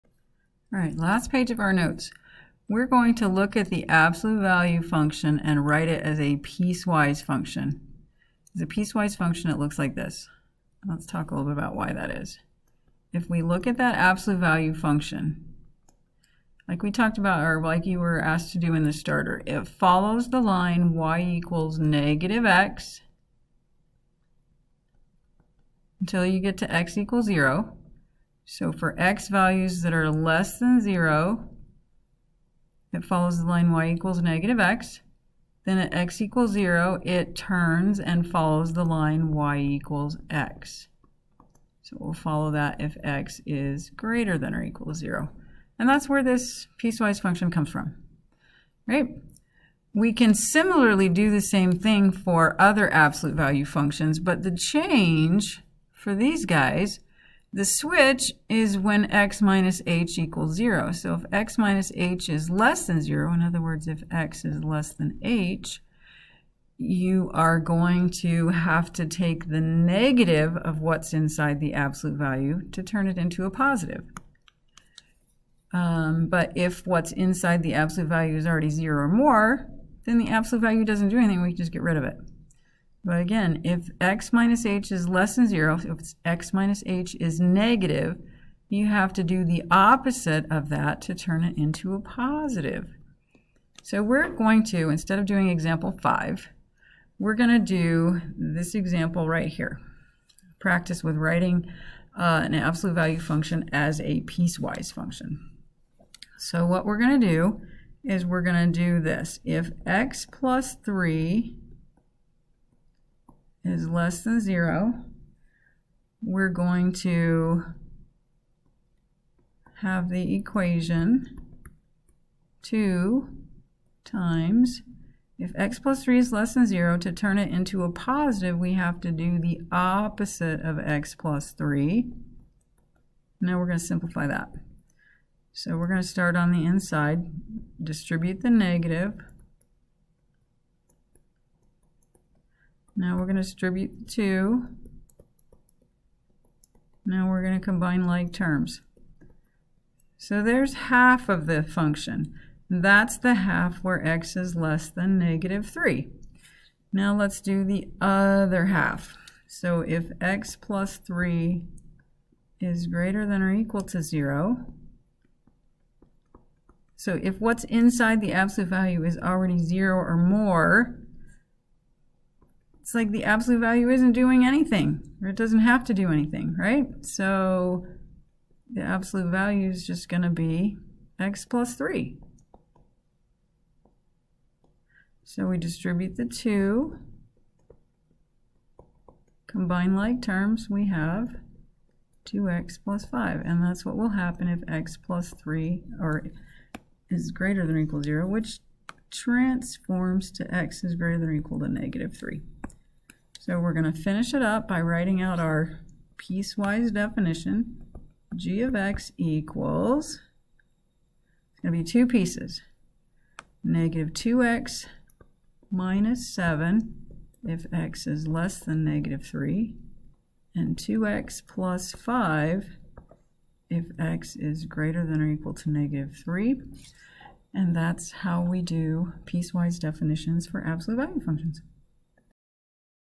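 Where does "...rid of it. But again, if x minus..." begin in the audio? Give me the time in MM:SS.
01:21.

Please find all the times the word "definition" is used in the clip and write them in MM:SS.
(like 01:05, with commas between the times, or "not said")
03:26, 03:49.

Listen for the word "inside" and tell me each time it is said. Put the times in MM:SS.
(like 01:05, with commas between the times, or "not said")
01:11, 01:17, 02:16, 02:47.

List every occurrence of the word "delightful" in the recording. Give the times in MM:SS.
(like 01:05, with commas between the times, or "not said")
not said.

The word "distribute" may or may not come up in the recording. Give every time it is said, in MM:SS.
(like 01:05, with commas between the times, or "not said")
02:17, 02:23, 03:05.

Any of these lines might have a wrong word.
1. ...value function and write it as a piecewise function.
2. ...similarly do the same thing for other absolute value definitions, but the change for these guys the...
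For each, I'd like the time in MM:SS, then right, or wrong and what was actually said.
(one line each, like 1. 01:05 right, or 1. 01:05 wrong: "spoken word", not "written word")
1. 00:04 right
2. 00:50 wrong: "functions", not "definitions".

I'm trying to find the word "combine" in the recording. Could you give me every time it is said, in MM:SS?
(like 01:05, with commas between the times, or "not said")
02:27, 03:09.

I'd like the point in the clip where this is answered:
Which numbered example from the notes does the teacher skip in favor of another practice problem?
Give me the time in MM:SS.
01:35.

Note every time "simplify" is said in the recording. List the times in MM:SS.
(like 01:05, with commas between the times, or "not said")
02:13.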